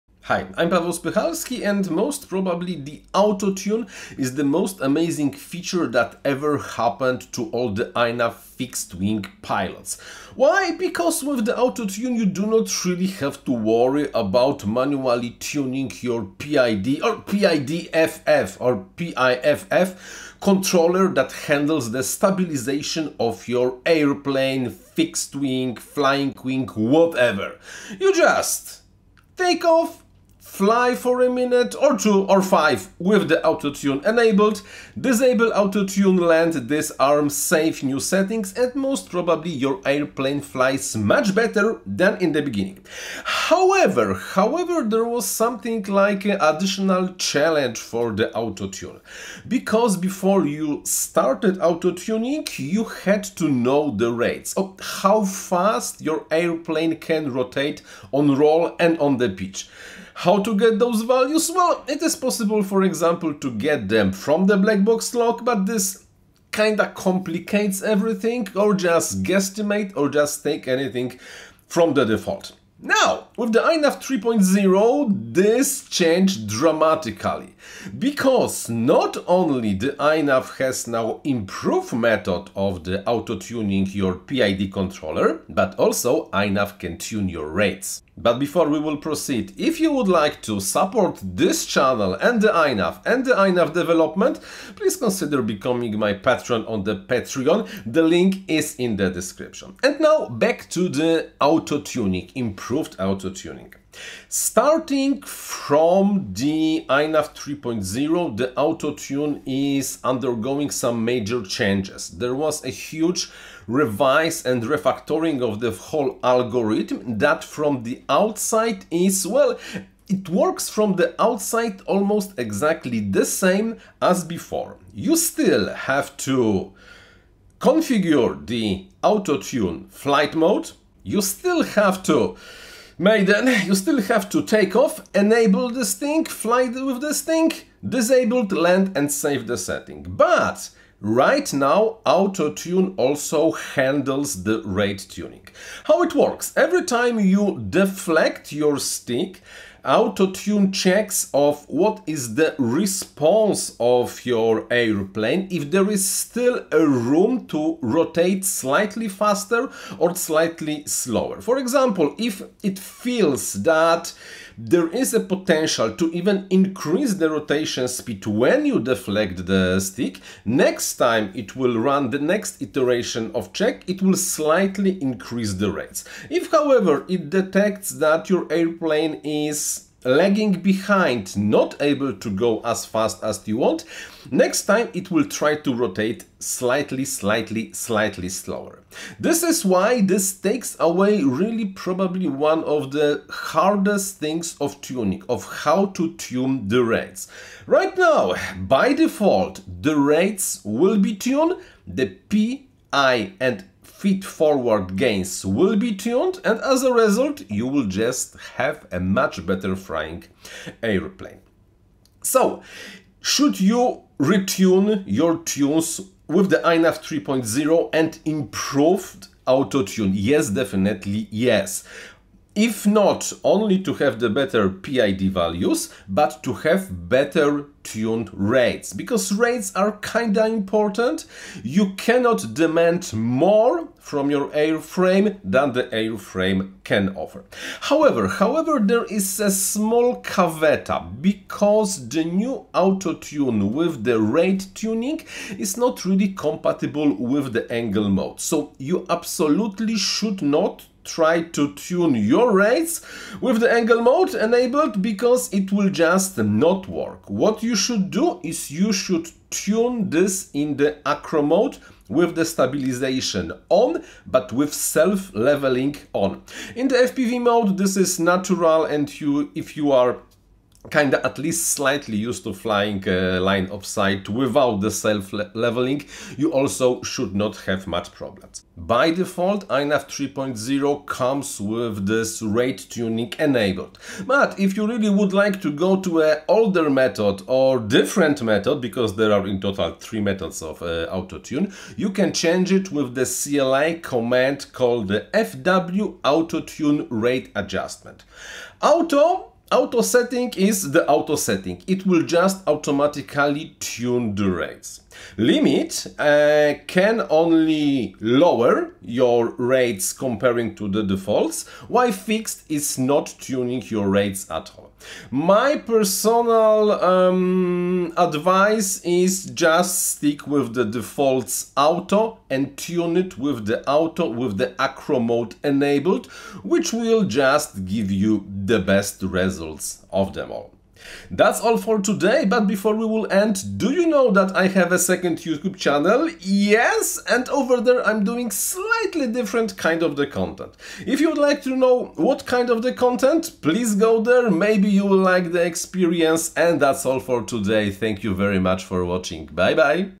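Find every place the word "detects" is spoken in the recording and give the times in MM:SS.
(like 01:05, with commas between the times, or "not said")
02:57.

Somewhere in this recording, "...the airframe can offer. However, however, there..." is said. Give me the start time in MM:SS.
03:55.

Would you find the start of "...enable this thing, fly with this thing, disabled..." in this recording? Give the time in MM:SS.
02:15.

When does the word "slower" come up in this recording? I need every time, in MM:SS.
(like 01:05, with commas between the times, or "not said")
02:40, 03:08.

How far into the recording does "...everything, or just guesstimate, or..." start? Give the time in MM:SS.
01:07.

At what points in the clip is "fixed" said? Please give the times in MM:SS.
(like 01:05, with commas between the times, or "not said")
00:08, 00:24, 05:12.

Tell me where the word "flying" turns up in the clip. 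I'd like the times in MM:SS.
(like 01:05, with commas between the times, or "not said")
00:25, 03:29, 04:32.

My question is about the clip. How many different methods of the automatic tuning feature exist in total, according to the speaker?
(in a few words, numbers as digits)
3.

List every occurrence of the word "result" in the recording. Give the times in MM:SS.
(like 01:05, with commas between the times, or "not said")
03:26, 05:29.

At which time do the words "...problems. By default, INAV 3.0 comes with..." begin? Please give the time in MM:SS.
04:38.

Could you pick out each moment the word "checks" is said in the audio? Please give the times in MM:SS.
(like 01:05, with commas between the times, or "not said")
02:30, 02:53.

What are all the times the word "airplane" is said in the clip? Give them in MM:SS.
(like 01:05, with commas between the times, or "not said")
00:23, 00:39, 00:56, 02:34, 02:58, 03:30.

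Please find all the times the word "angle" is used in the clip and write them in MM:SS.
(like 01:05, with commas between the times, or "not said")
04:07, 04:13.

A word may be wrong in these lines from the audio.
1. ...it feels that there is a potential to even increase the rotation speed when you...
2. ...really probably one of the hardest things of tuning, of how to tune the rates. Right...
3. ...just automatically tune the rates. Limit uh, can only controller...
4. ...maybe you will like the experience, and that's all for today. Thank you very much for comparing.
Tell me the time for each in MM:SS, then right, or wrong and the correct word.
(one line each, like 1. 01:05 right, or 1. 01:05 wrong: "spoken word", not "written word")
1. 02:42 right
2. 03:11 right
3. 05:02 wrong: "lower", not "controller"
4. 05:44 wrong: "watching", not "comparing".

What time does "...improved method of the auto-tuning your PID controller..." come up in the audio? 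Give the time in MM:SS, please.
01:21.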